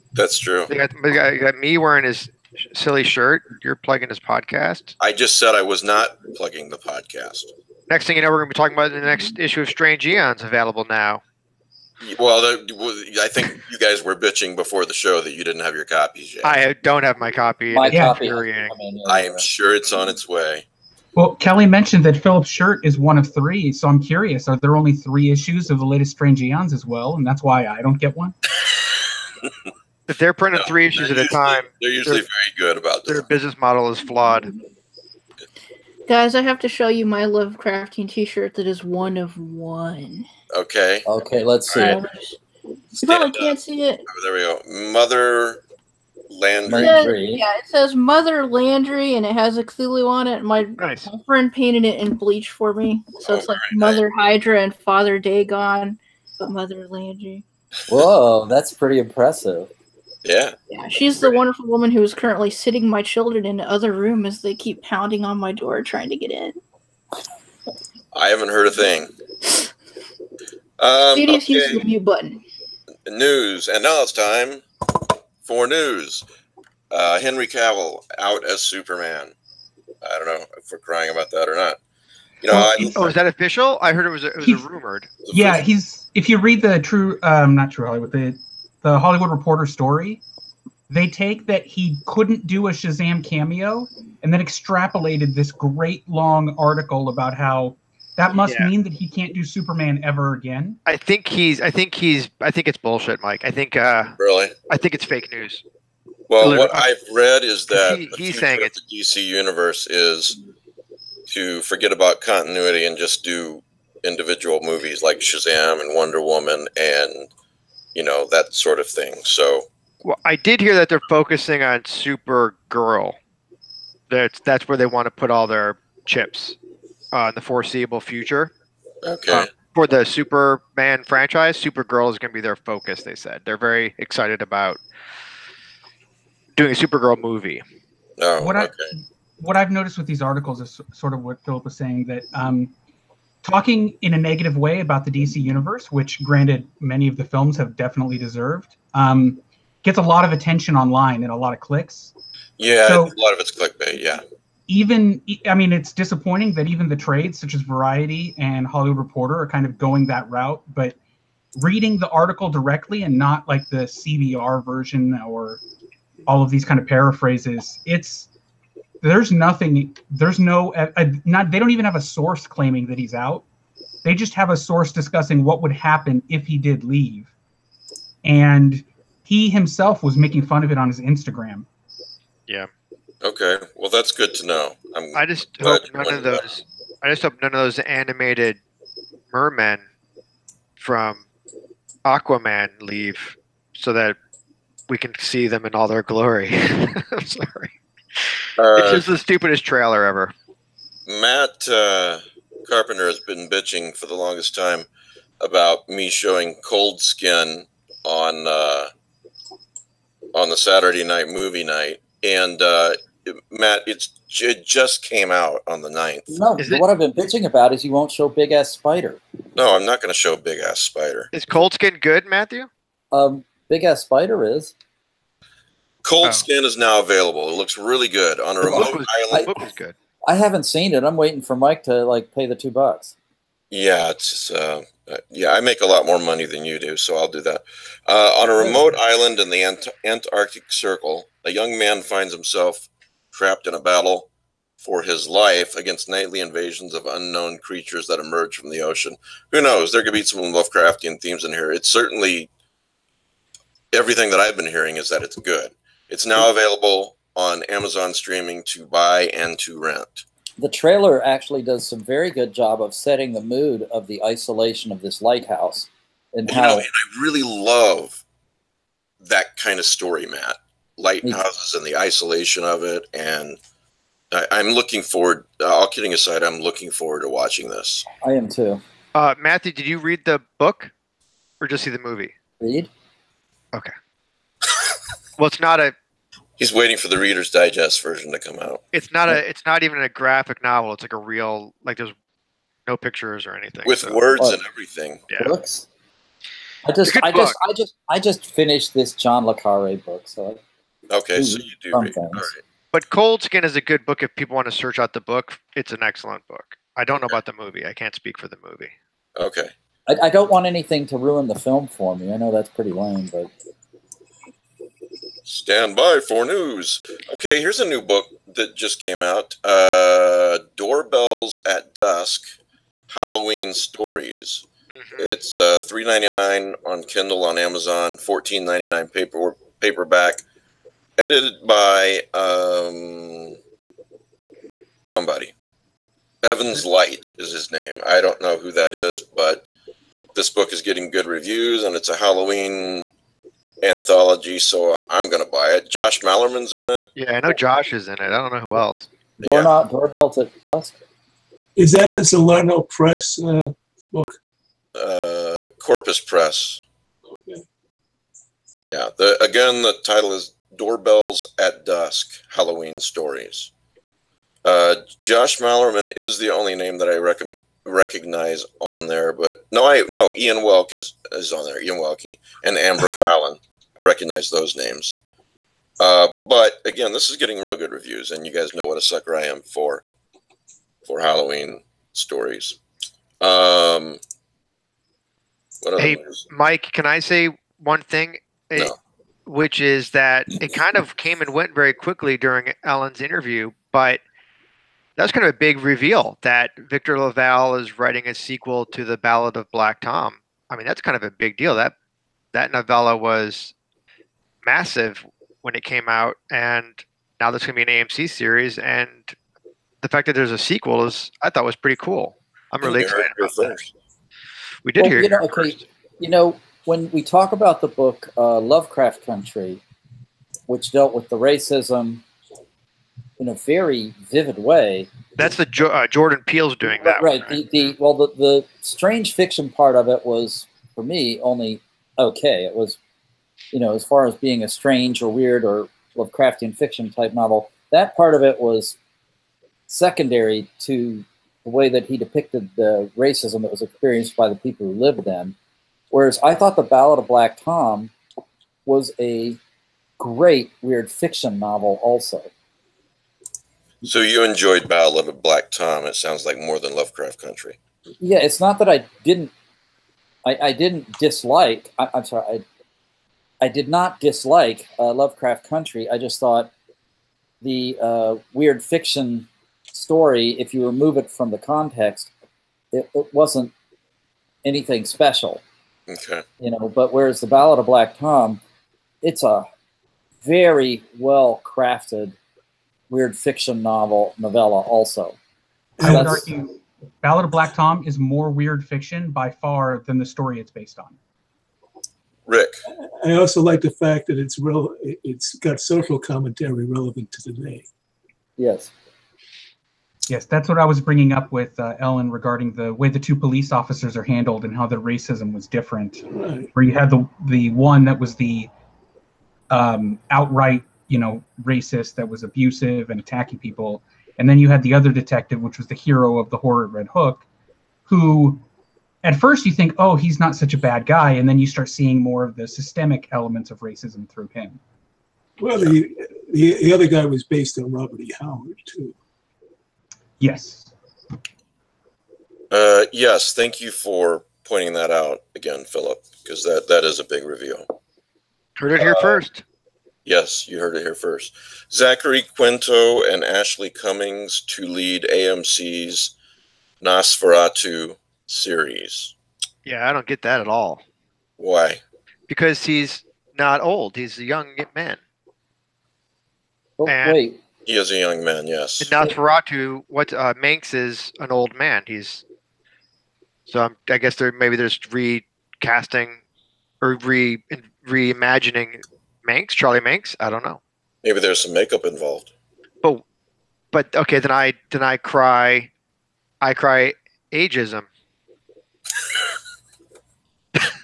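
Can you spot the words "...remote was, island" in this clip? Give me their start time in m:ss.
3:48.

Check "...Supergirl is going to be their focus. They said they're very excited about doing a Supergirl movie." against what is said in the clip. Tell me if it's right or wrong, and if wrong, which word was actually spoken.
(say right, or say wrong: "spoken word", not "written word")
right.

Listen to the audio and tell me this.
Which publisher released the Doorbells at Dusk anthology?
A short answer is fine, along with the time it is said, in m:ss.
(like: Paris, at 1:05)
Corpus Press, at 5:55.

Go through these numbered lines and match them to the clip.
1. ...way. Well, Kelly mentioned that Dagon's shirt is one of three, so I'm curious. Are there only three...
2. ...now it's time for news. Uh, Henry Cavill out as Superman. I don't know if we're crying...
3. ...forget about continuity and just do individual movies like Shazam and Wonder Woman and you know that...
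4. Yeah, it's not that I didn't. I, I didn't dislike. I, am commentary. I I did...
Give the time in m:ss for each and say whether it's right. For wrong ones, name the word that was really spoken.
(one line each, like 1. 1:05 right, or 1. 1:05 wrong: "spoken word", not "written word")
1. 0:20 wrong: "Philip", not "Dagon"
2. 1:13 right
3. 1:51 right
4. 7:38 wrong: "sorry", not "commentary".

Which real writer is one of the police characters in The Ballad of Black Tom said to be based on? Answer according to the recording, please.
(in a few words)
Robert E. Howard.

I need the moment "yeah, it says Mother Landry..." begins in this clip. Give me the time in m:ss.
0:47.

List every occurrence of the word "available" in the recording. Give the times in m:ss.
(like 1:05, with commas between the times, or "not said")
0:10, 3:47, 4:16.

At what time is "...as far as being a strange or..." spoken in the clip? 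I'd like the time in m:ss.
7:13.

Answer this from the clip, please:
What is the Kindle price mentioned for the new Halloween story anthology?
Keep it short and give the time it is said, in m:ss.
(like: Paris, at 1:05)
$3.99, at 5:25.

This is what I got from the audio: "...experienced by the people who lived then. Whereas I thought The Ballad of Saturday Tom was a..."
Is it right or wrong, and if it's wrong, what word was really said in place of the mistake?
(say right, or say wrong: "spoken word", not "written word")
wrong: "Black", not "Saturday".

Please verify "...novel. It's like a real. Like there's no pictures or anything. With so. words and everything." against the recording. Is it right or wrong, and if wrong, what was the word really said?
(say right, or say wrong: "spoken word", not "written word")
right.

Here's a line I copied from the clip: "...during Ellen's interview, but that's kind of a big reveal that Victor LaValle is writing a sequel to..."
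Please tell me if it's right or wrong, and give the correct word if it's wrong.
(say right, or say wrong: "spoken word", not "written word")
right.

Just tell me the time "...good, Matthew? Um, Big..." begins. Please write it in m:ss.
3:42.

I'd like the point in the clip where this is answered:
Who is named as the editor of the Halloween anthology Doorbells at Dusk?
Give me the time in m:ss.
5:36.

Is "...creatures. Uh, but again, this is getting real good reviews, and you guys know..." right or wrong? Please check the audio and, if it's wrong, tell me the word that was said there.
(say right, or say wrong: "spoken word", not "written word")
wrong: "names", not "creatures".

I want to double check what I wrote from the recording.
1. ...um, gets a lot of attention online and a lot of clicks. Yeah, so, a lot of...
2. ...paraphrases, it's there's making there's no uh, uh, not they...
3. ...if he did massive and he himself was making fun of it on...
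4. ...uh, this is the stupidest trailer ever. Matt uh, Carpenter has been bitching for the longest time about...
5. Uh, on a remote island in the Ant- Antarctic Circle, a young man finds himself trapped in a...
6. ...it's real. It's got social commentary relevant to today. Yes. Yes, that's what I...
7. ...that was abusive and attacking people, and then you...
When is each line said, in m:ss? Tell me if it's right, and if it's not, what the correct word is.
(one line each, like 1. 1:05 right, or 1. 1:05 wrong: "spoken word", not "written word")
1. 2:28 right
2. 2:46 wrong: "nothing", not "making"
3. 2:56 wrong: "leave", not "massive"
4. 3:18 right
5. 3:58 right
6. 8:14 right
7. 8:32 right.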